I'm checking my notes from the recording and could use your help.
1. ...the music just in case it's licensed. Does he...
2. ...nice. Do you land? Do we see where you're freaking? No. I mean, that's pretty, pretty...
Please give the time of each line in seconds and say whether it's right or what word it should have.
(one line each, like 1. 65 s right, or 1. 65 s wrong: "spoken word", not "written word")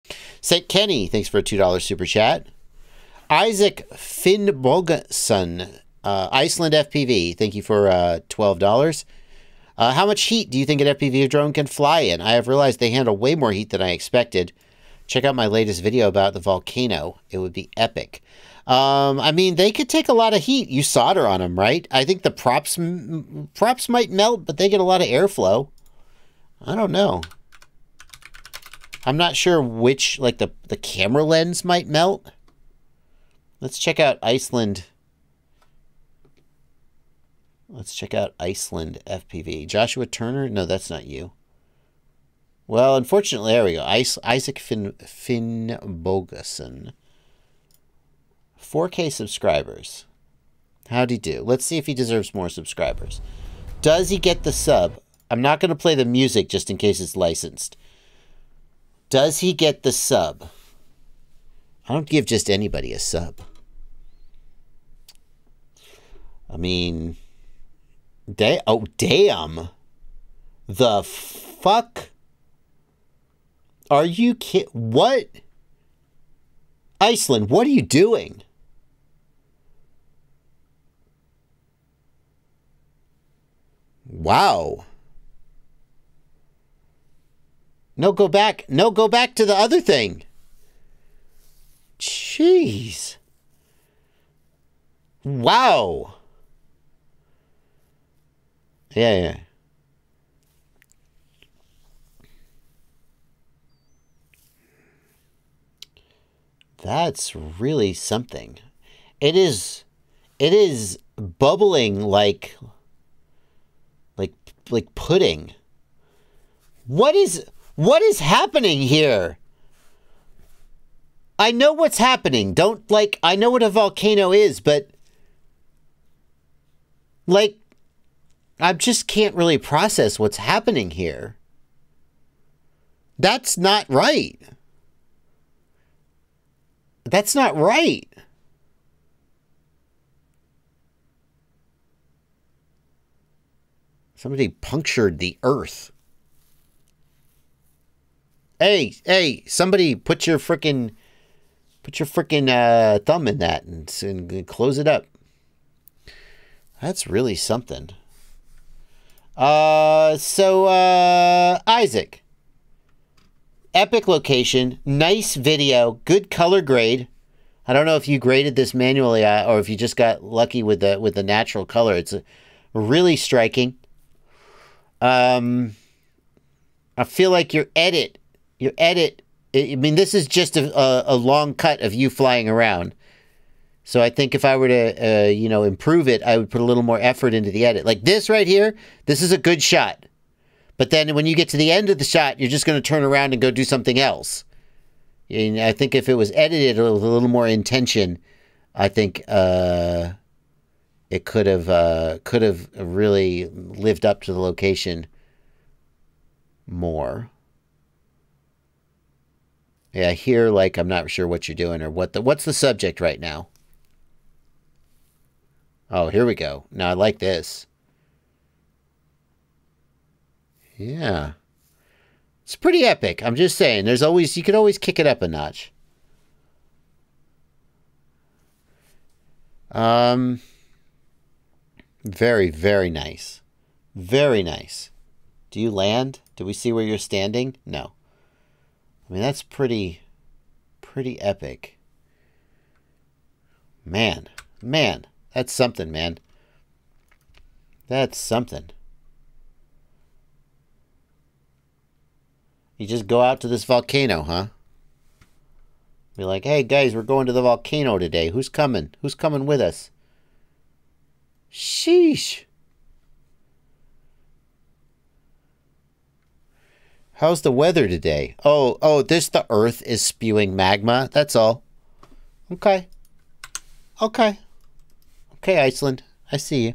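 1. 55 s right
2. 234 s wrong: "standing", not "freaking".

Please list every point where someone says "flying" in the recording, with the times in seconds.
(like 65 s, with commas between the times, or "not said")
182 s.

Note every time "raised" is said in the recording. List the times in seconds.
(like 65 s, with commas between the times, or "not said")
not said.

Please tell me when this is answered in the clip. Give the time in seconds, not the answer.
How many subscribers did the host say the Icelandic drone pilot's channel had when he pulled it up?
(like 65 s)
48 s.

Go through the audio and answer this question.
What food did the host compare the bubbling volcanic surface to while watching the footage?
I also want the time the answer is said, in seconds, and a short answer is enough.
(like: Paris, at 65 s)
Pudding, at 114 s.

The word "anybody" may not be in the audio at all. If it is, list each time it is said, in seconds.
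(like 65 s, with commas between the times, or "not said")
62 s.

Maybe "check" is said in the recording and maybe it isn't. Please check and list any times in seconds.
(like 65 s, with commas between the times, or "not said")
15 s, 33 s, 37 s.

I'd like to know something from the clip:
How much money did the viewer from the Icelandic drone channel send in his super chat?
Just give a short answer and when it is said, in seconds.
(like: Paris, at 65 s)
$12, at 8 s.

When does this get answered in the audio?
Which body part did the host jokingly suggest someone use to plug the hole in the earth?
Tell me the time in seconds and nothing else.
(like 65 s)
152 s.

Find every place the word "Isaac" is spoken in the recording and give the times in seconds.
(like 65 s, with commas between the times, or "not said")
3 s, 43 s, 161 s.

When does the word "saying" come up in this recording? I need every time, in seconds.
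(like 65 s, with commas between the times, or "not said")
223 s.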